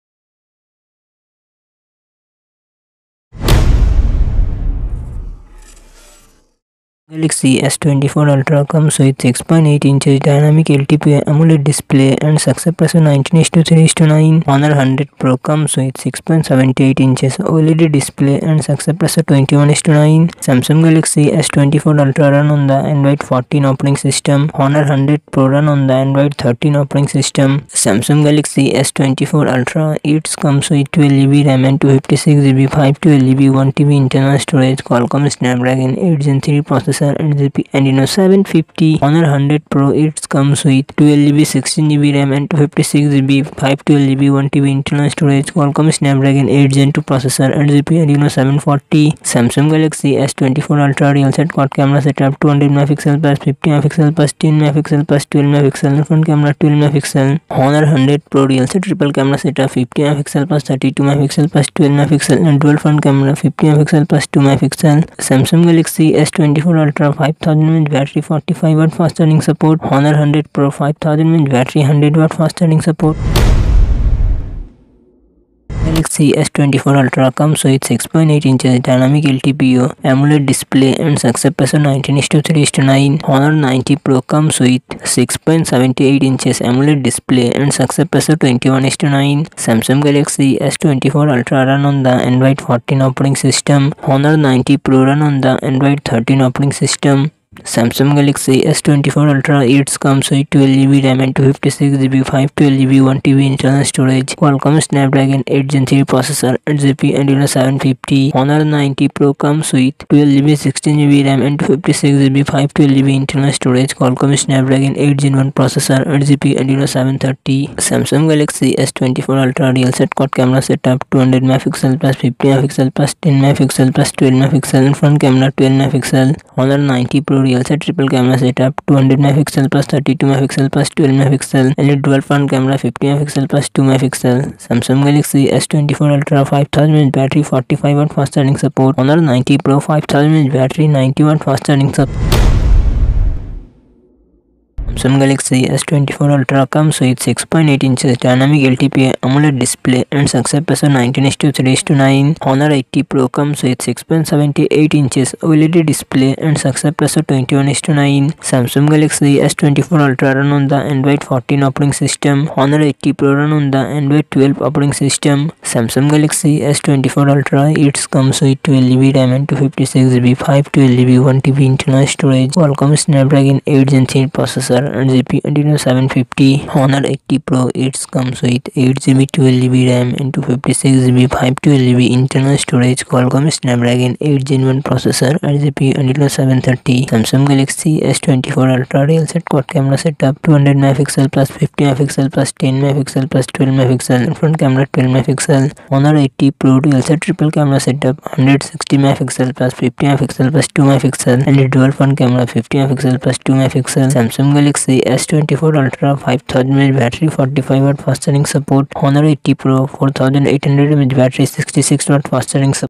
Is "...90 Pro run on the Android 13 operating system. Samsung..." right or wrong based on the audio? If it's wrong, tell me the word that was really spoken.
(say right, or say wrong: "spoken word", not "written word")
right.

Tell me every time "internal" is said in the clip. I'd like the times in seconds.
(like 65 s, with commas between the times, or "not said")
34 s, 44 s, 103 s, 113 s, 171 s, 182 s.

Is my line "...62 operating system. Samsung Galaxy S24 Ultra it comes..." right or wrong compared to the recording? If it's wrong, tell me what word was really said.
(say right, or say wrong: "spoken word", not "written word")
wrong: "12", not "62".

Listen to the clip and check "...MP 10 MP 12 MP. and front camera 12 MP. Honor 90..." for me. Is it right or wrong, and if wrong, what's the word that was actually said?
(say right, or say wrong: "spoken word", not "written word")
right.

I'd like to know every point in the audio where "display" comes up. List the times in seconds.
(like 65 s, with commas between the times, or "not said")
11 s, 17 s, 80 s, 87 s, 149 s, 155 s.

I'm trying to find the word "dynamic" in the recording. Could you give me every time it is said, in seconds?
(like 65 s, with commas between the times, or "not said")
10 s, 78 s, 148 s.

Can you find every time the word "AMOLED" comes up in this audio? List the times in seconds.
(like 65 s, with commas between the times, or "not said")
11 s, 80 s, 86 s, 149 s.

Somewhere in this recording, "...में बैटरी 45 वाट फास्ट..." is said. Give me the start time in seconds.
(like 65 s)
67 s.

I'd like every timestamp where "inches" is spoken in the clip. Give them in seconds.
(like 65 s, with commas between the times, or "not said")
9 s, 17 s, 78 s, 86 s, 147 s, 155 s.